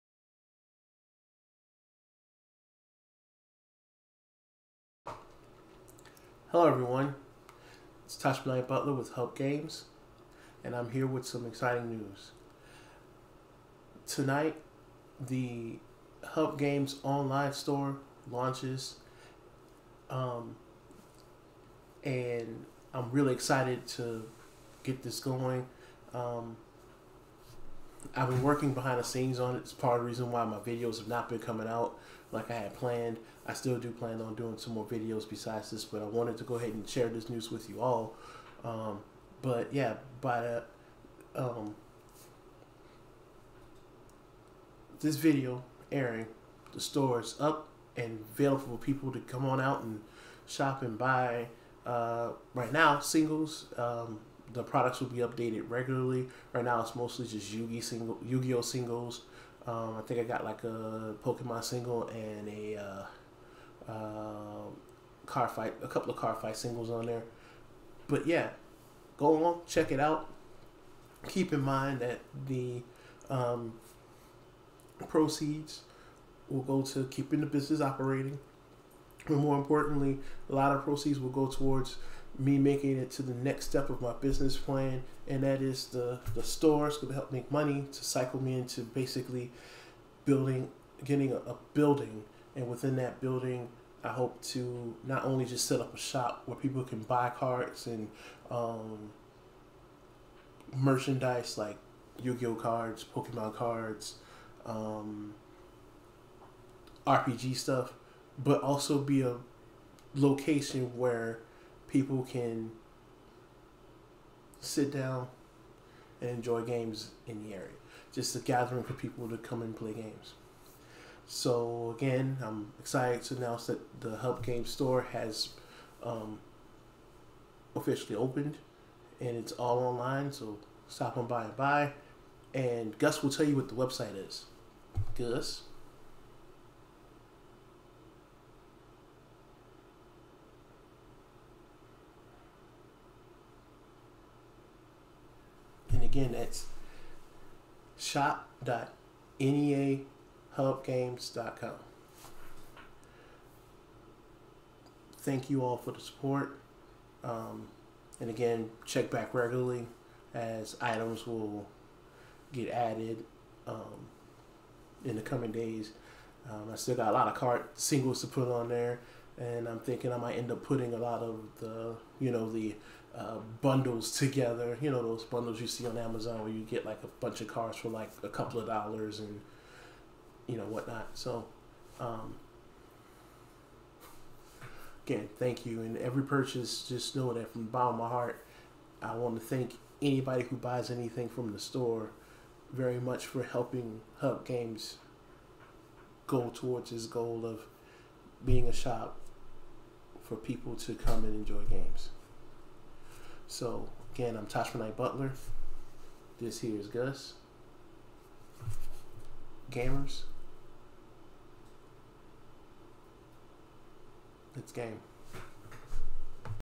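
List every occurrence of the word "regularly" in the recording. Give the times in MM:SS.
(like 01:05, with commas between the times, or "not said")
00:55, 02:39.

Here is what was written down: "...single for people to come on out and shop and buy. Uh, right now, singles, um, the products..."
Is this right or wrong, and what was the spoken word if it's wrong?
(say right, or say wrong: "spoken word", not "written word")
wrong: "available", not "single".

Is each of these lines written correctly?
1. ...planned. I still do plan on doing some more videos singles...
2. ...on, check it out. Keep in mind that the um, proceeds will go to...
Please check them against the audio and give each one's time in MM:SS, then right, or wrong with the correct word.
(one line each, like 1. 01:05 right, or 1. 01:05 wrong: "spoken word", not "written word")
1. 00:32 wrong: "besides", not "singles"
2. 01:09 right.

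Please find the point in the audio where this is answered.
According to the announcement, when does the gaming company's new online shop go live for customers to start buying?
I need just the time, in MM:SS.
00:14.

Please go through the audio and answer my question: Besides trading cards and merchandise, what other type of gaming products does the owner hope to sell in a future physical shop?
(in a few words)
RPG stuff.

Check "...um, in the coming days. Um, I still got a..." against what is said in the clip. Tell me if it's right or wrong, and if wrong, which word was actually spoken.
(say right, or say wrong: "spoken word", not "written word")
right.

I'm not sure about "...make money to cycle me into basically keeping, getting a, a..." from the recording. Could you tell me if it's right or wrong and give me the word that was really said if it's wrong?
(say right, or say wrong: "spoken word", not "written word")
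wrong: "building", not "keeping".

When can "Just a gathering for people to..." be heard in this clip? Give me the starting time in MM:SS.
01:58.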